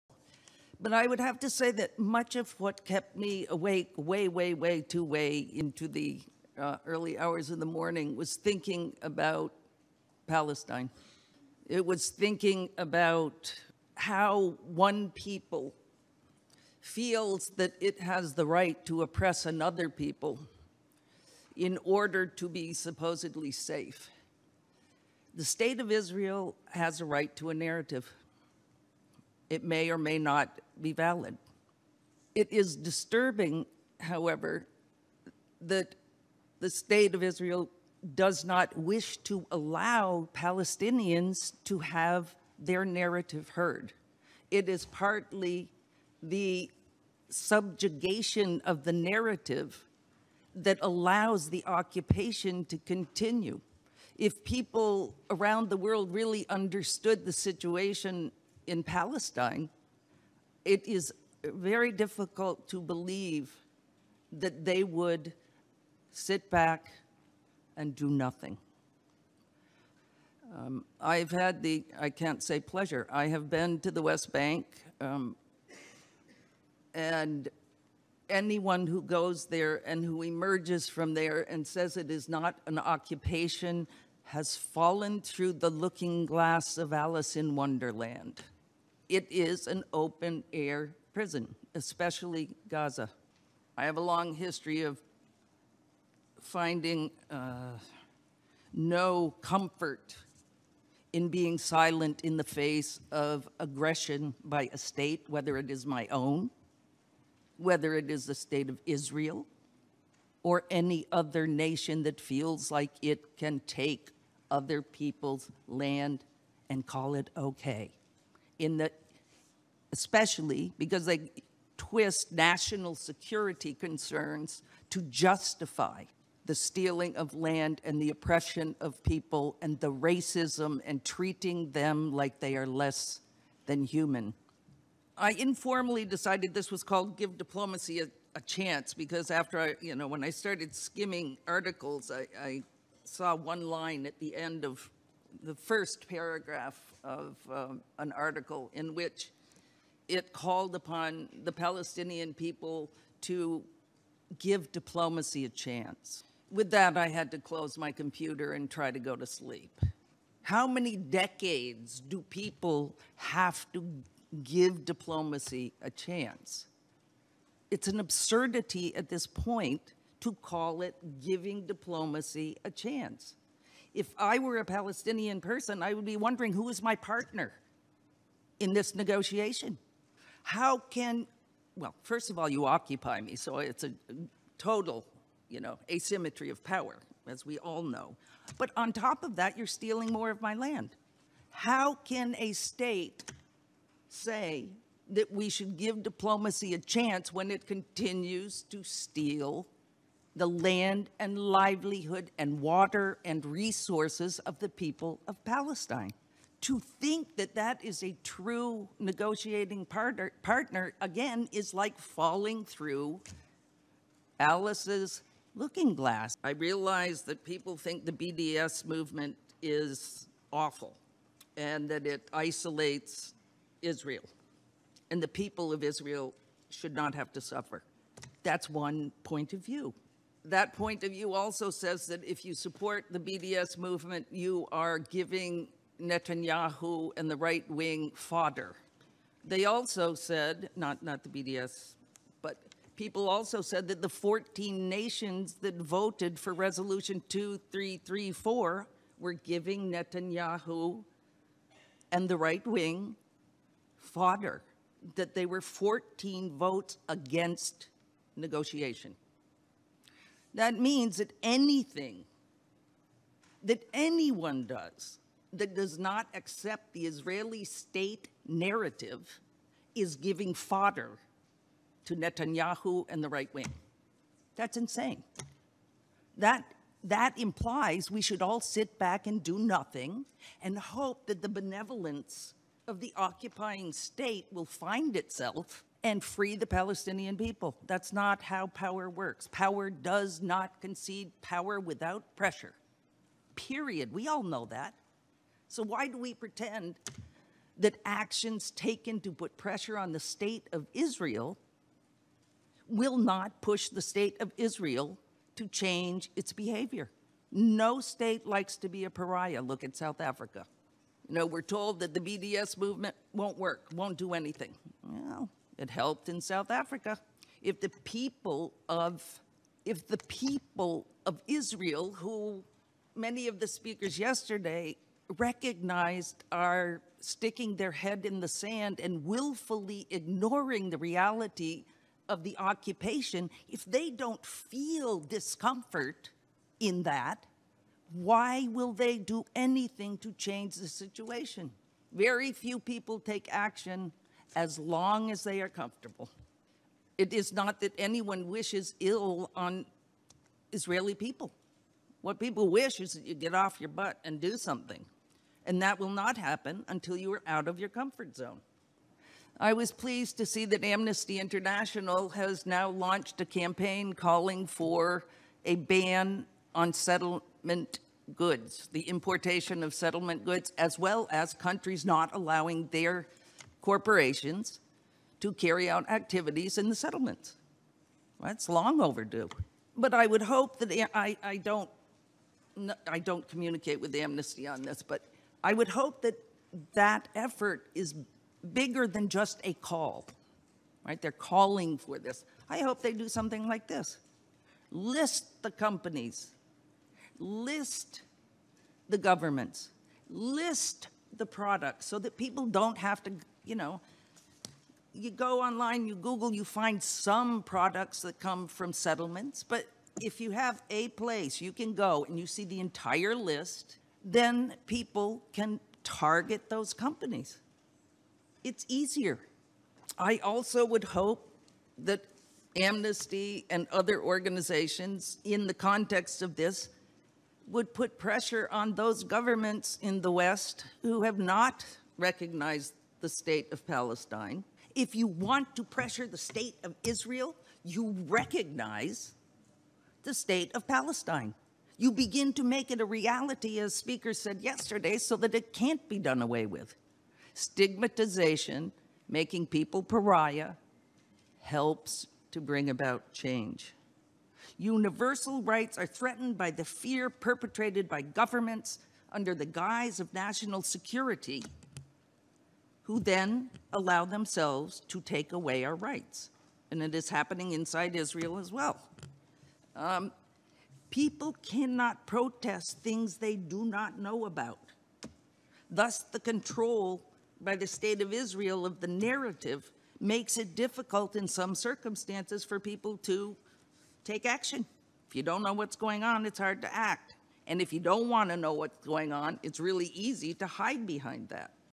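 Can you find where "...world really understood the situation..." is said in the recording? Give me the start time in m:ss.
0:55.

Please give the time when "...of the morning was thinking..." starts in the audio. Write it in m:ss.
0:07.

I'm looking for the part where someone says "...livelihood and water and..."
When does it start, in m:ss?
3:21.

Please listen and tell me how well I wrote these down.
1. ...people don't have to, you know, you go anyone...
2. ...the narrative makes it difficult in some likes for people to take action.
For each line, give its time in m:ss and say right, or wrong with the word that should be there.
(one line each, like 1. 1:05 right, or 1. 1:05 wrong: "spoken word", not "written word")
1. 6:42 wrong: "online", not "anyone"
2. 7:59 wrong: "circumstances", not "likes".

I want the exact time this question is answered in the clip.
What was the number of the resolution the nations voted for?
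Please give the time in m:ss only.
4:07.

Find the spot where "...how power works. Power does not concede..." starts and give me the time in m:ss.
4:48.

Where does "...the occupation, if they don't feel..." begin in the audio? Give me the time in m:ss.
5:32.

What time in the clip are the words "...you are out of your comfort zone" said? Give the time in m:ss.
5:57.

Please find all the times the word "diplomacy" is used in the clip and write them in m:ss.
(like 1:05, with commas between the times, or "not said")
2:17, 2:34, 2:44, 2:51, 3:16.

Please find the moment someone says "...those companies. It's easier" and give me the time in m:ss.
6:56.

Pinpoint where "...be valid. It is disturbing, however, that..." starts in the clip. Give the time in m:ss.
0:30.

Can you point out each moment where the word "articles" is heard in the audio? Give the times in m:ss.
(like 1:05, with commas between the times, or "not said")
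2:21, 2:28.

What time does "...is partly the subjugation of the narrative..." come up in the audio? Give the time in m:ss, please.
0:44.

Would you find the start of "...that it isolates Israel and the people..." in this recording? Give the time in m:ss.
3:41.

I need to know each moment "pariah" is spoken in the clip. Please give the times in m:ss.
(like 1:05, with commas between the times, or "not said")
5:09, 7:30.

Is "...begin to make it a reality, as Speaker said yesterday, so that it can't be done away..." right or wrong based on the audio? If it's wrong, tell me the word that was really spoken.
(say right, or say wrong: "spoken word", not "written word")
right.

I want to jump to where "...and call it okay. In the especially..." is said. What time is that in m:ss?
1:56.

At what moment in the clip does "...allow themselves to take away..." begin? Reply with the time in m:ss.
7:43.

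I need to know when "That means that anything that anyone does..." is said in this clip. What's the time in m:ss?
4:20.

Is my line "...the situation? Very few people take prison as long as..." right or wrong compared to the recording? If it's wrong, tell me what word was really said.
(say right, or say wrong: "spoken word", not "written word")
wrong: "action", not "prison".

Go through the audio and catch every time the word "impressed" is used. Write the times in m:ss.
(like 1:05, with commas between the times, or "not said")
not said.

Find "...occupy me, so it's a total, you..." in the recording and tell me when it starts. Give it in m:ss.
3:02.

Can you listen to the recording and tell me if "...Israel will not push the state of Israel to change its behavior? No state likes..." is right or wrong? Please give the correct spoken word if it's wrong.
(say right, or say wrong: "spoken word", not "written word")
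right.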